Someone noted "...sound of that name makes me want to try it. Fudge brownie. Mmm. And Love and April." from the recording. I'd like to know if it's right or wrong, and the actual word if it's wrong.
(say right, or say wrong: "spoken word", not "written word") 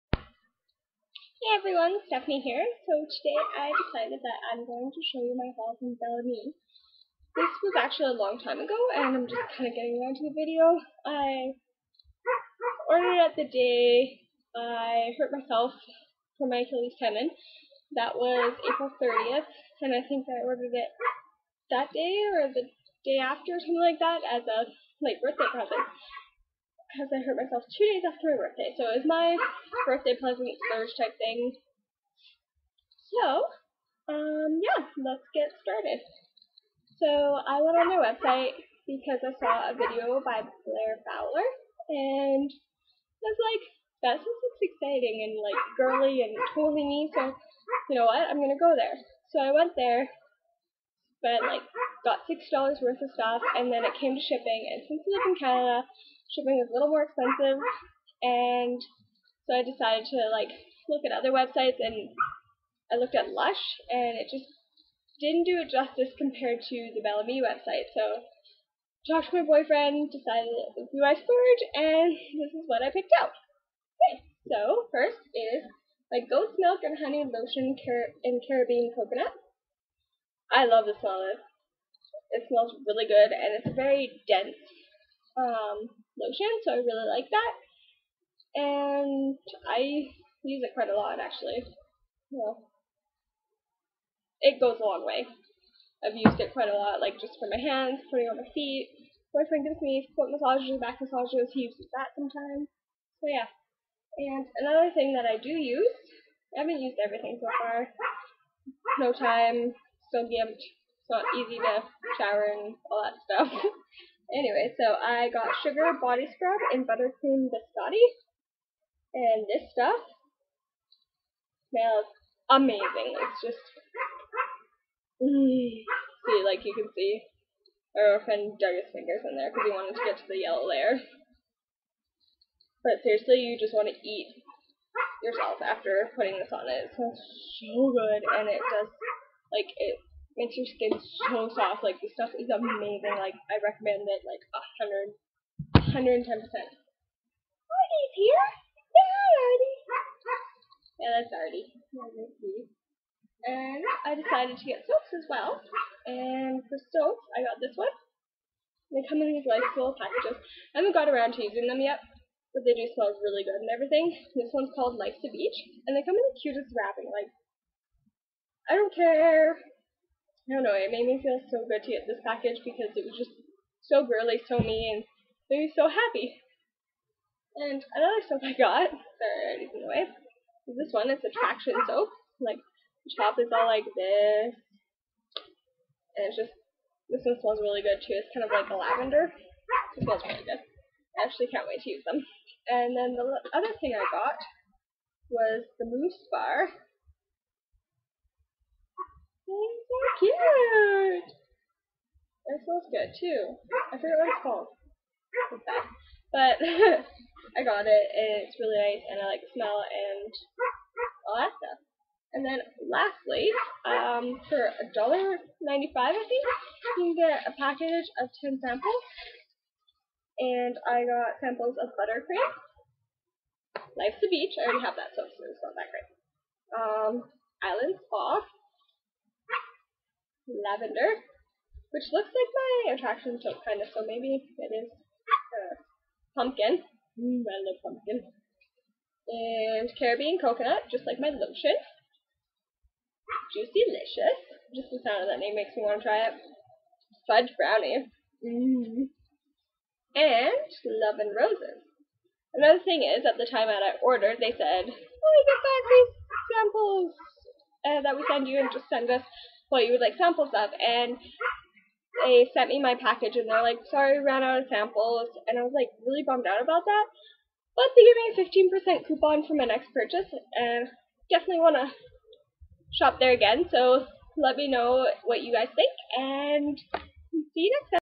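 wrong: "Roses", not "April".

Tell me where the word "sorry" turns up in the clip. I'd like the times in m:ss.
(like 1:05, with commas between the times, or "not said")
2:58, 4:23.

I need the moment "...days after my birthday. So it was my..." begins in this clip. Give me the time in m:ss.
0:27.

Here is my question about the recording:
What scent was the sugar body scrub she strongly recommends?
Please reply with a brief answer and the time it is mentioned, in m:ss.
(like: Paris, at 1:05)
Buttercream biscotti, at 1:56.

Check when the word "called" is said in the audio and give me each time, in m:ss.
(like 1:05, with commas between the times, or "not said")
2:44, 3:24.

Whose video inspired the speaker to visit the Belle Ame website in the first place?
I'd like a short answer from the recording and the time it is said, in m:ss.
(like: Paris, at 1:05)
Blair Fowler, at 0:40.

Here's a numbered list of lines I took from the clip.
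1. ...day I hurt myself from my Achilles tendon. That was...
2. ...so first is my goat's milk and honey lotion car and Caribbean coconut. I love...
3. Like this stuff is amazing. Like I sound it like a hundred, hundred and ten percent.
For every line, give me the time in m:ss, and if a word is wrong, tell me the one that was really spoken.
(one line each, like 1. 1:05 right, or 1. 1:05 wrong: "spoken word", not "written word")
1. 0:13 right
2. 1:14 right
3. 2:21 wrong: "recommend", not "sound".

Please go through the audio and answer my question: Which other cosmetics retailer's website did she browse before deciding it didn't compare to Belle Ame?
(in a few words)
Lush.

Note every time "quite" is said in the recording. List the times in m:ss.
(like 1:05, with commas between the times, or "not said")
1:30, 1:36.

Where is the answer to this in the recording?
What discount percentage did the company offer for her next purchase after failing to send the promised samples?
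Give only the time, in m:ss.
4:28.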